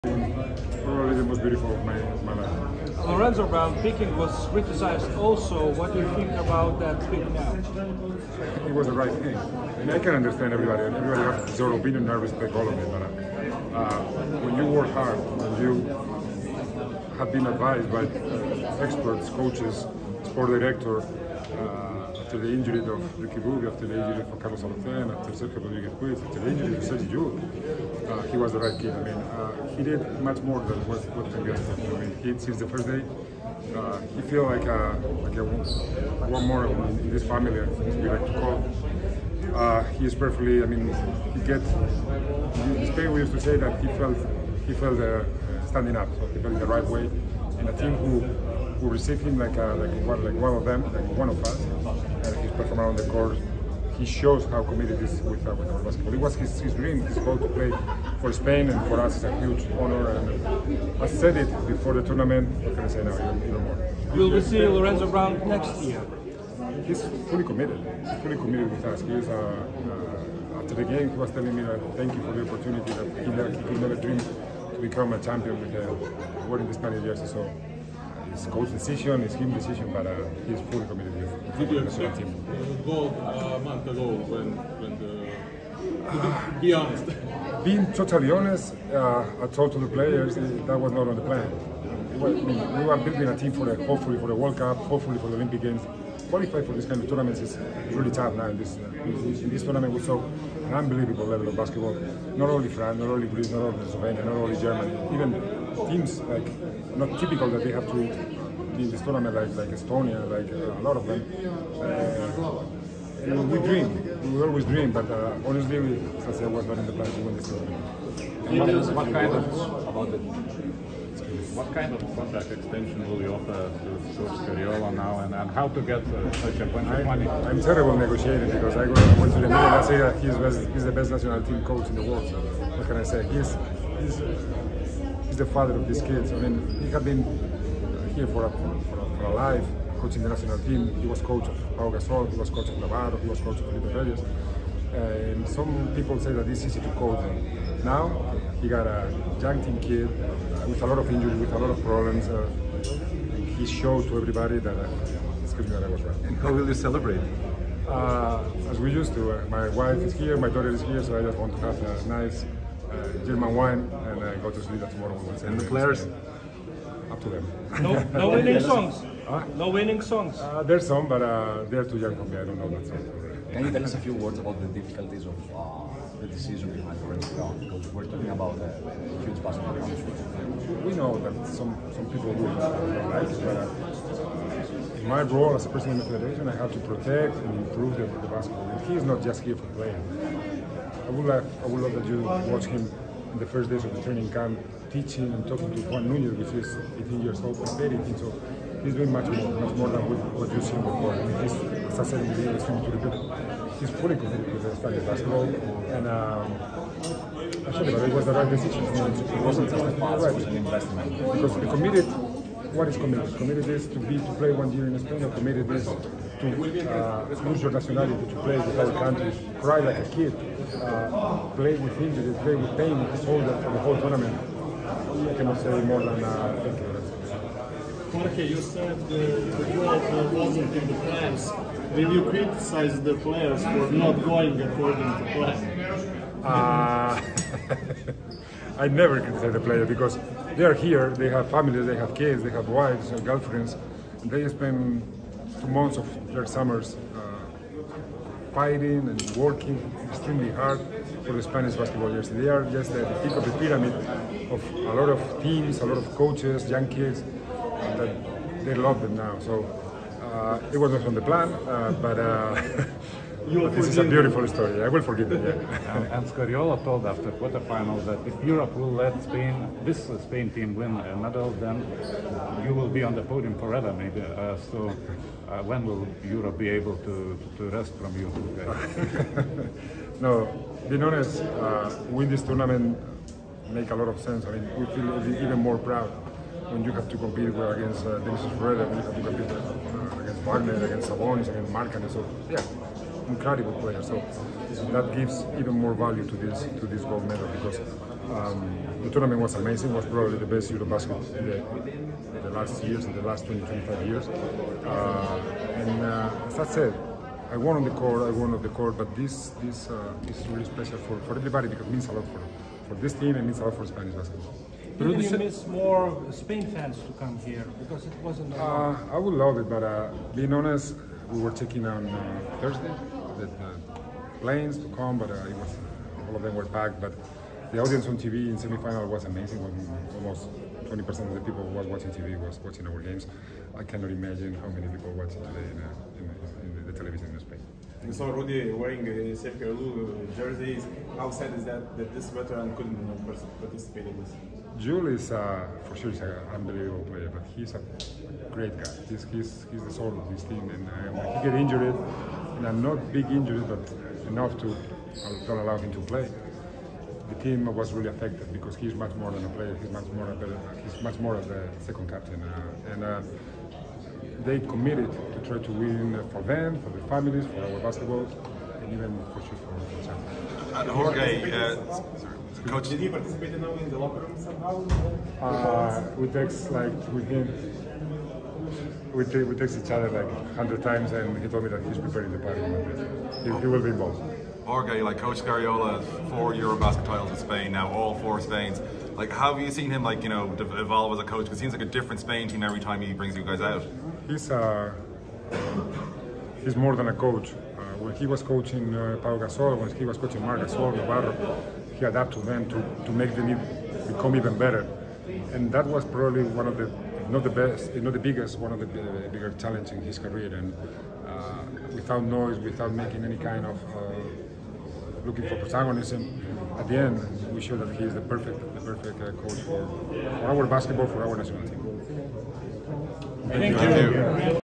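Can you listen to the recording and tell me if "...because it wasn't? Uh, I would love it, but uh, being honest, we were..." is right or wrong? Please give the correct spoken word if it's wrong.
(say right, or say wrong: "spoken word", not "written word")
right.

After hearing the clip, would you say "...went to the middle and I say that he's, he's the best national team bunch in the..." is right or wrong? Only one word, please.
wrong.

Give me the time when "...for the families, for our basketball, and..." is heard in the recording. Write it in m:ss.
6:06.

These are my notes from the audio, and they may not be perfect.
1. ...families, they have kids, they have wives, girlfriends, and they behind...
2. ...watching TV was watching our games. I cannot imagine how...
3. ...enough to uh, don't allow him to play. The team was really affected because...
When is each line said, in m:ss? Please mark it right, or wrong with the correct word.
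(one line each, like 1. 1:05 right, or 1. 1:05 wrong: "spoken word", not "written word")
1. 4:01 wrong: "spend", not "behind"
2. 5:31 right
3. 5:54 right.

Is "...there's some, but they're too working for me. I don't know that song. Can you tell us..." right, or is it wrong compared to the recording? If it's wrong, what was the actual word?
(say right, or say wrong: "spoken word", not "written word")
wrong: "young", not "working".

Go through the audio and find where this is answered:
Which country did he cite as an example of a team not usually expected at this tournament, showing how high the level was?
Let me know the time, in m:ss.
1:49.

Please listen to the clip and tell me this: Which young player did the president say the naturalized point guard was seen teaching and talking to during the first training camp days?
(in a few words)
Juan Nunez.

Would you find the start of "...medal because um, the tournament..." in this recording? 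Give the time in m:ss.
4:57.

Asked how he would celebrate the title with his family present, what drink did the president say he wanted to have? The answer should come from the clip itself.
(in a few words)
wine.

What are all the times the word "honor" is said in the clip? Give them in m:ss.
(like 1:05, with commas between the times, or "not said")
0:59.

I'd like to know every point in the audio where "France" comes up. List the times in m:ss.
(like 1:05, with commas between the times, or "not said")
1:42.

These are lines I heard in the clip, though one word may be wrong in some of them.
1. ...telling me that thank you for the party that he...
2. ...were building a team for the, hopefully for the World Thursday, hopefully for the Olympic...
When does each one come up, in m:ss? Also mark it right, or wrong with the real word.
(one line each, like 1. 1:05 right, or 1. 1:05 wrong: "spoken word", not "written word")
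1. 1:11 wrong: "opportunity", not "party"
2. 1:32 wrong: "Cup", not "Thursday".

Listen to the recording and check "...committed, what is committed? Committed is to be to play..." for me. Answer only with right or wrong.
right.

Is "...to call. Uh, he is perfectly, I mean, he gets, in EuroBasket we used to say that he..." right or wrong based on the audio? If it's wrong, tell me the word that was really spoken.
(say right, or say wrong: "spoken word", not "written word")
wrong: "Spain", not "EuroBasket".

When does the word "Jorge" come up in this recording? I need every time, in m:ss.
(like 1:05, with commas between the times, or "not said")
3:48, 6:10, 6:24.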